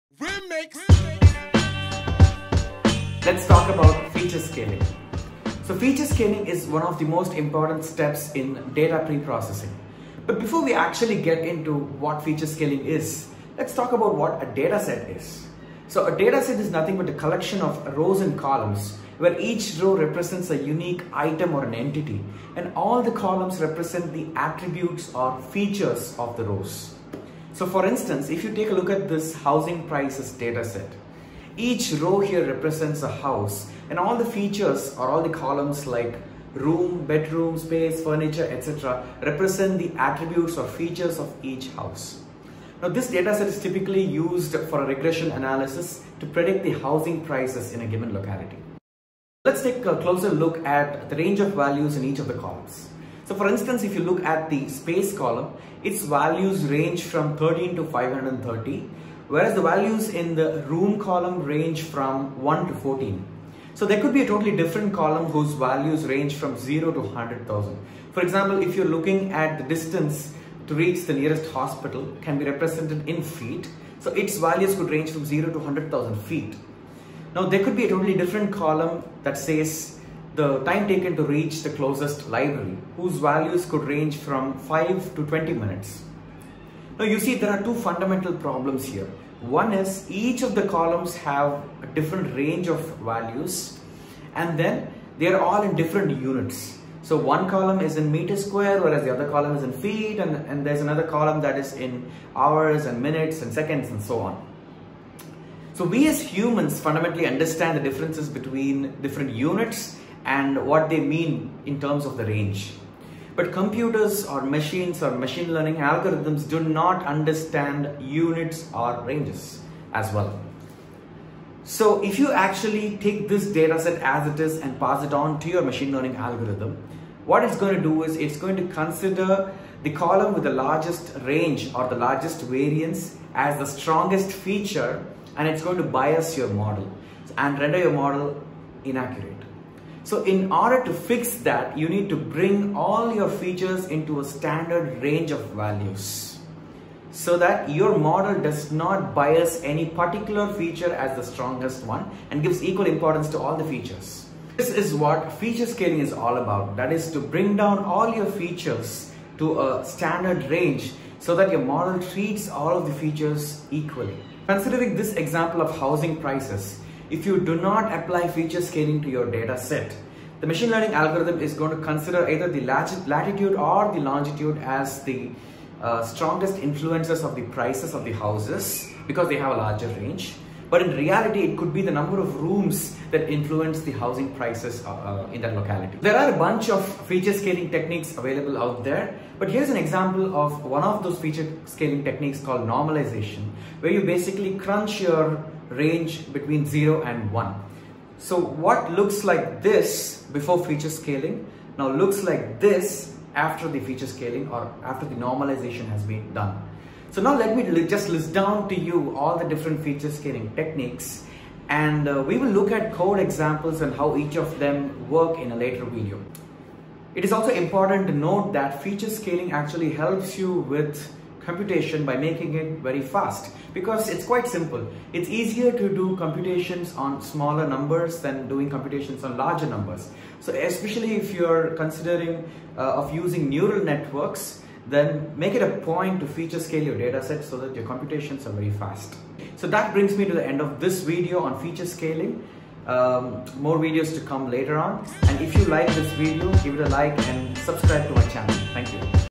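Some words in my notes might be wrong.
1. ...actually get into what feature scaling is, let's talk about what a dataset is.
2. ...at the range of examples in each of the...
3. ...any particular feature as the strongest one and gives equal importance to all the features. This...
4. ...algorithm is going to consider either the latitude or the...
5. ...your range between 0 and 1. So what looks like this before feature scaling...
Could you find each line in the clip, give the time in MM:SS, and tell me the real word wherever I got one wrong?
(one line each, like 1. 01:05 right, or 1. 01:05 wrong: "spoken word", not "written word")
1. 00:10 right
2. 00:50 wrong: "values", not "examples"
3. 02:29 right
4. 02:50 right
5. 03:15 right.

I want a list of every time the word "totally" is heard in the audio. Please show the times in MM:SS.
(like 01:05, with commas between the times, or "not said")
01:04, 01:17.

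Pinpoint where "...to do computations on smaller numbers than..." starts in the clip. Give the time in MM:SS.
03:45.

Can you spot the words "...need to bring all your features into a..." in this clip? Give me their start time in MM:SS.
02:21.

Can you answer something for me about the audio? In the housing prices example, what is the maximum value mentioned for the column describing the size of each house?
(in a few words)
530.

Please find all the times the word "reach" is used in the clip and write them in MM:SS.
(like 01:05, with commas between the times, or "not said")
01:10, 01:21.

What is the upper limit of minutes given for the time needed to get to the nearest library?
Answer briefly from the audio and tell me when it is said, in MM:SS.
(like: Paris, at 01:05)
20, at 01:25.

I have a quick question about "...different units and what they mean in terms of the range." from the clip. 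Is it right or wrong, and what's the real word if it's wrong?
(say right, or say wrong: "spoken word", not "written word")
right.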